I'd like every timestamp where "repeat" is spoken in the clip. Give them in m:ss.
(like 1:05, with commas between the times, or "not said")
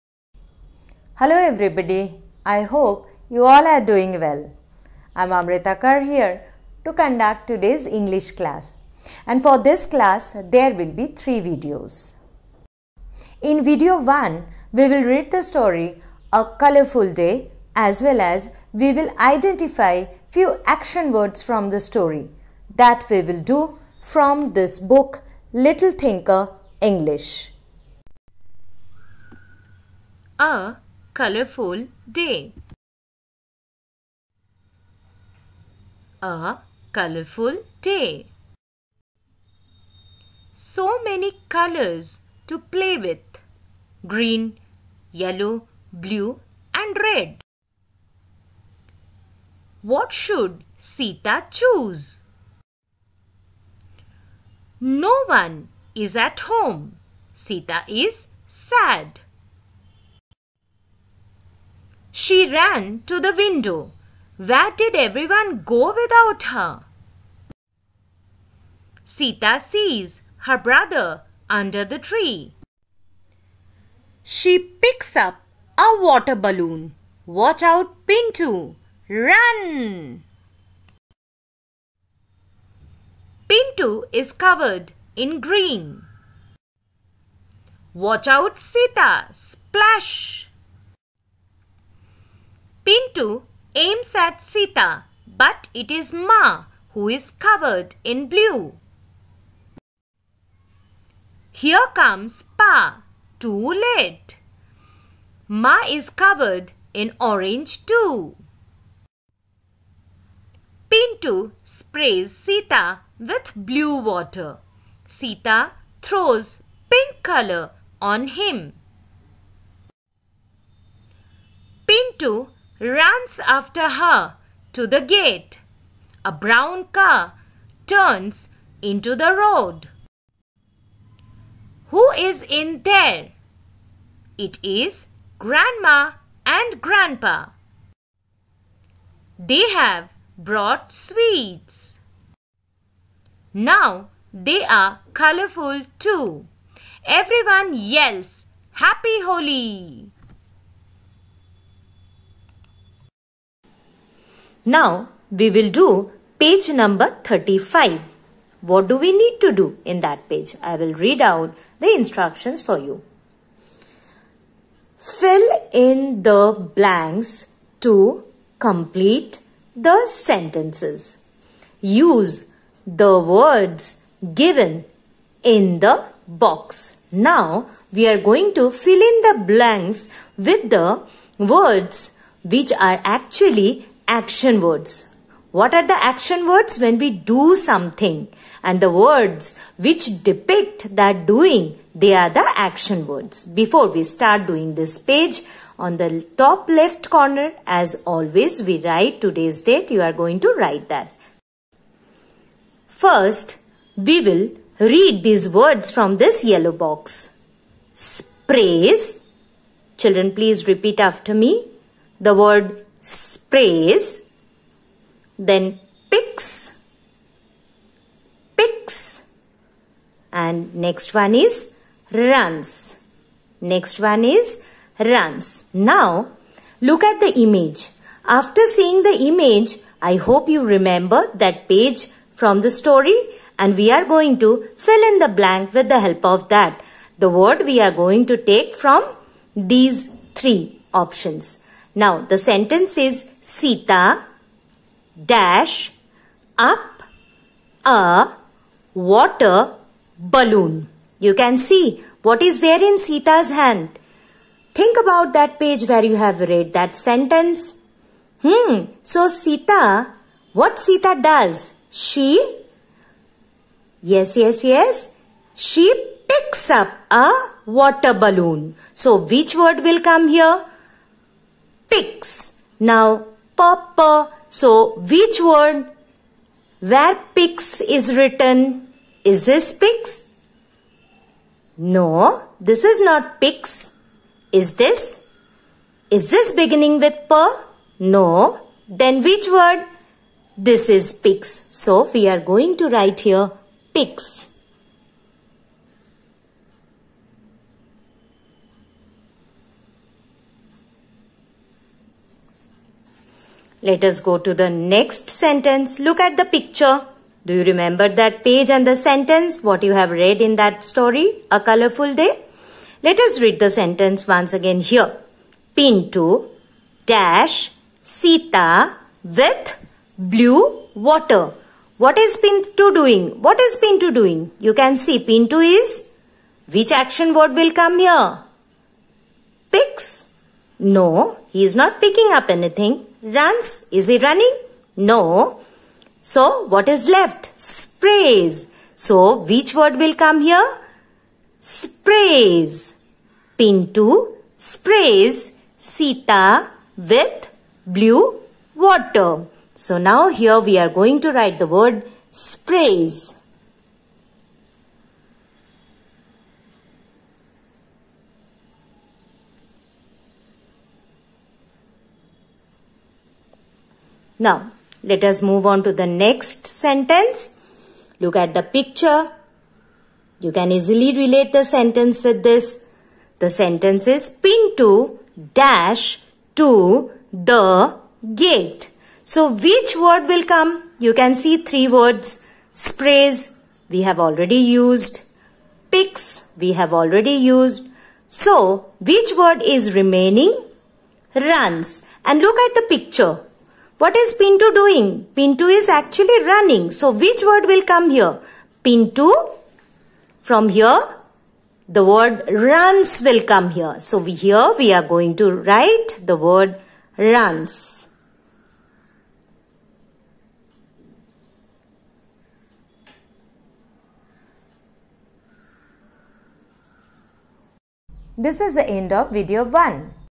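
3:30.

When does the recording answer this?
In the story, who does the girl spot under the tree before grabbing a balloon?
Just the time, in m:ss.
1:10.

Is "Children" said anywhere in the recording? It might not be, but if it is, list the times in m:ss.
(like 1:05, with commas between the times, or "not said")
3:29.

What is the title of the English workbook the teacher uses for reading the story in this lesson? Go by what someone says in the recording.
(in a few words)
Little Thinker English.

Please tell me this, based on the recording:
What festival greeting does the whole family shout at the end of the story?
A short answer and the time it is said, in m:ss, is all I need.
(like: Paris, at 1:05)
Happy Holi, at 2:28.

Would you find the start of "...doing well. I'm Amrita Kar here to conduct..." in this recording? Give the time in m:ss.
0:03.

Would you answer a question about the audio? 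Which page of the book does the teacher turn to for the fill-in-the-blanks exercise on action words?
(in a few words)
35.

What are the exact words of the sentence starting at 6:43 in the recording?
So we, here we are going to write the word runs.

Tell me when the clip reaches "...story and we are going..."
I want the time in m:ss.
3:52.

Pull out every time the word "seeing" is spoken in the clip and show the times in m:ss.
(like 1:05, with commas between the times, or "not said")
3:48.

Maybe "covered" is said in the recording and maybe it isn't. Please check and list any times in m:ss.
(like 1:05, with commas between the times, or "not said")
1:24, 1:37, 1:46.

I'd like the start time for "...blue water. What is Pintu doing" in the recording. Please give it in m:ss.
5:20.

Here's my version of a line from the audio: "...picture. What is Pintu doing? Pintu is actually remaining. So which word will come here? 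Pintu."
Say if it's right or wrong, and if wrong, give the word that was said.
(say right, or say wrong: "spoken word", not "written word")
wrong: "running", not "remaining".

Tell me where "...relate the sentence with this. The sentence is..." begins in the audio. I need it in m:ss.
6:11.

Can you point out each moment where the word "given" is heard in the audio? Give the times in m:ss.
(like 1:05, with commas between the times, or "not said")
2:54.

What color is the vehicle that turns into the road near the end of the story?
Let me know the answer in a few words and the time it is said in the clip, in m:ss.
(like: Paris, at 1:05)
Brown, at 2:06.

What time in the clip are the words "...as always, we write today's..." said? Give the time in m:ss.
3:17.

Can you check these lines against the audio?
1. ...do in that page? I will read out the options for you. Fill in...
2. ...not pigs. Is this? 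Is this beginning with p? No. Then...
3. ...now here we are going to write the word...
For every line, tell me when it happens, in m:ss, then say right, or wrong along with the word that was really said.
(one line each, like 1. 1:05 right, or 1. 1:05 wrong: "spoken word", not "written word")
1. 2:39 wrong: "instructions", not "options"
2. 4:43 right
3. 5:49 right.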